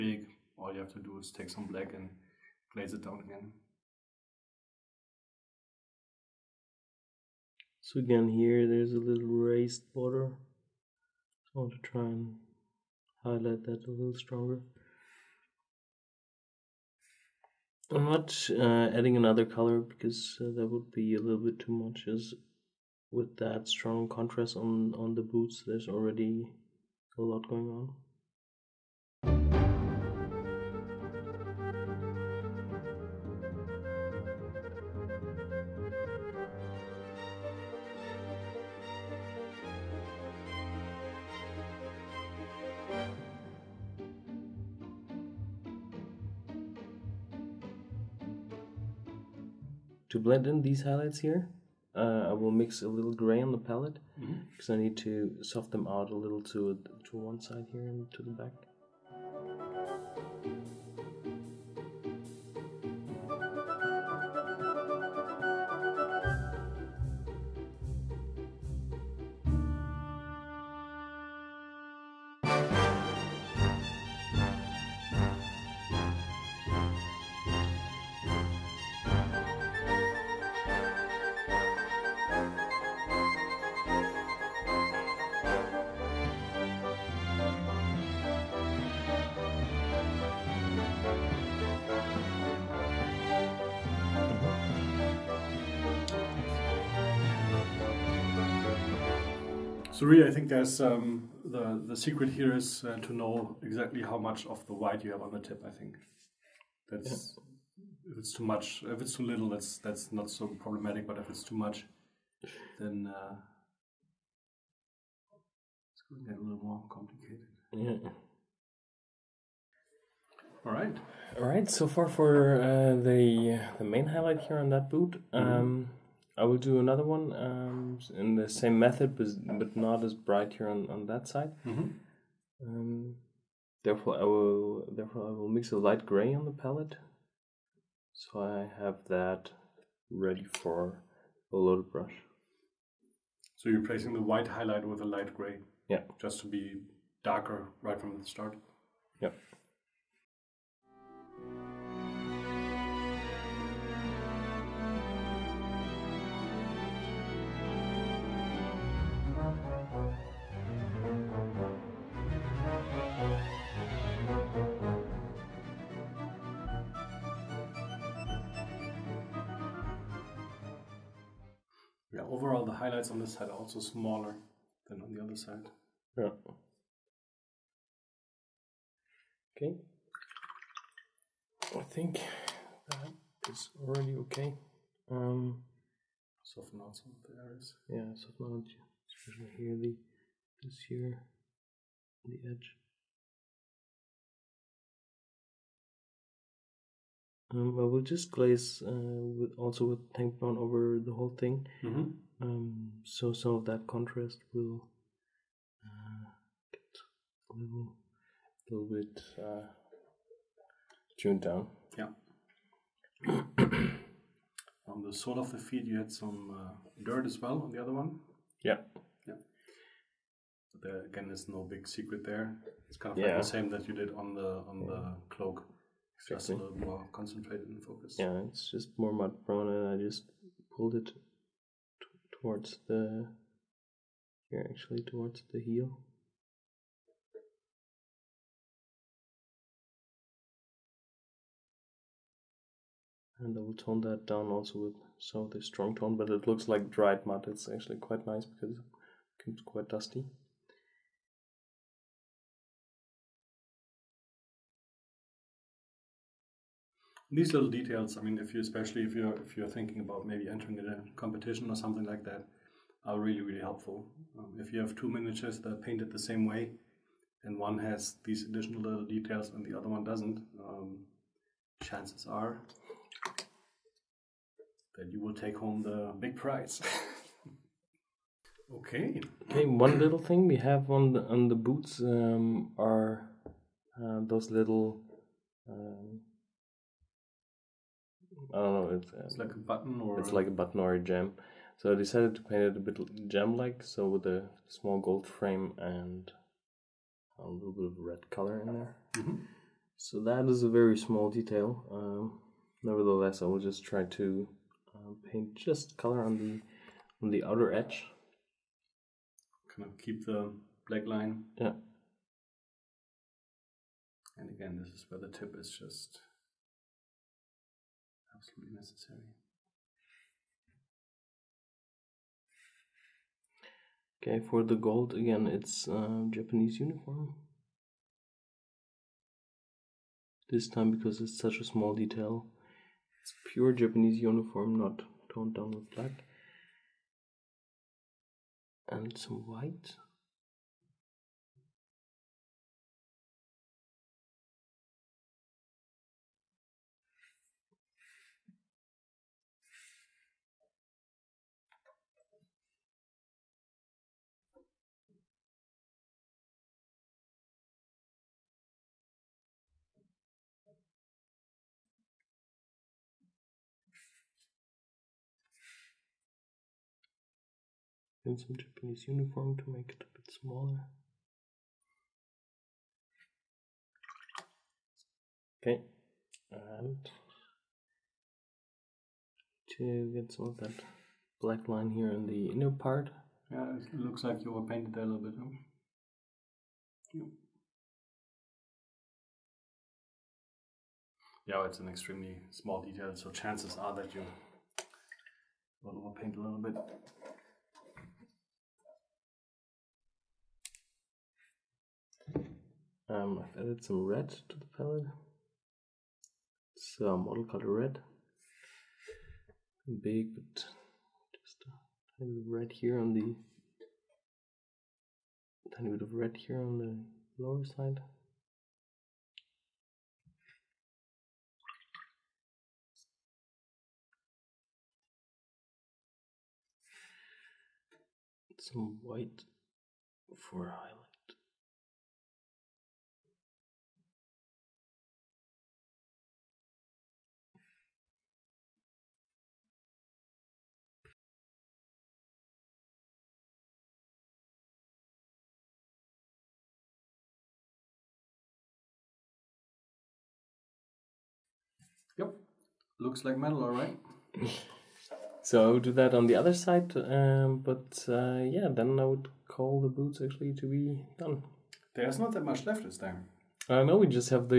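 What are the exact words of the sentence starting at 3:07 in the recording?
Yeah, soften out especially here the this here the edge.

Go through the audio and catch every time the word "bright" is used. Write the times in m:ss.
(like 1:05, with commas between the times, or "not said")
2:10.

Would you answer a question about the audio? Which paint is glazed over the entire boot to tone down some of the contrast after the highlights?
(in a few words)
tank brown.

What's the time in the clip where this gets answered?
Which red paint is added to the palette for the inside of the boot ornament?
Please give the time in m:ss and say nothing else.
6:47.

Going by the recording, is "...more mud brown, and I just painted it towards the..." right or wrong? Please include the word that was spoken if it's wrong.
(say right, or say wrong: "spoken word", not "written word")
wrong: "pulled", not "painted".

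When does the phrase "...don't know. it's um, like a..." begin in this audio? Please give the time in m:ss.
4:48.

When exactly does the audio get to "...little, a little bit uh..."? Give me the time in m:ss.
3:27.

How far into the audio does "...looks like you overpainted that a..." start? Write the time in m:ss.
6:23.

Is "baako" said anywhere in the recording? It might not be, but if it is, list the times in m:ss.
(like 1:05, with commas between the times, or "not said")
not said.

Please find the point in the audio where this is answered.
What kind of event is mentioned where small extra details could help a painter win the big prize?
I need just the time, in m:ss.
4:20.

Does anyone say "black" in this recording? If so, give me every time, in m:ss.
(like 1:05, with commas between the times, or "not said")
0:01, 5:10, 5:35, 6:21.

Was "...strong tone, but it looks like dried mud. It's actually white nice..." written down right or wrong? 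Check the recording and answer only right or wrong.
wrong.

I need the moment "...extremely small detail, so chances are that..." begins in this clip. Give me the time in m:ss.
6:31.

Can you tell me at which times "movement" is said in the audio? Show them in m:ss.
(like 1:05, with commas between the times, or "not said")
not said.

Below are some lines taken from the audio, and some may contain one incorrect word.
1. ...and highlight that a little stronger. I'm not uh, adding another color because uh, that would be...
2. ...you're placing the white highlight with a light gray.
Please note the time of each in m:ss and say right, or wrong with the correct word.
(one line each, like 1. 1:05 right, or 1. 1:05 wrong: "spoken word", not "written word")
1. 0:12 right
2. 2:23 right.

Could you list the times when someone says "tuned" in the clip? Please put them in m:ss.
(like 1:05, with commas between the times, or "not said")
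3:31.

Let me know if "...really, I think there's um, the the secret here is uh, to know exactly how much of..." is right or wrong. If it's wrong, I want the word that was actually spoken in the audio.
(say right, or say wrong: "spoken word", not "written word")
right.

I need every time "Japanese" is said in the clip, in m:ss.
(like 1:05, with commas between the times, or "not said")
5:26, 5:33, 6:08.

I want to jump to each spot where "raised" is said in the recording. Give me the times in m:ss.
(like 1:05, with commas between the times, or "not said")
0:09.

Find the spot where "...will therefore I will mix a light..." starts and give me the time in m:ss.
2:14.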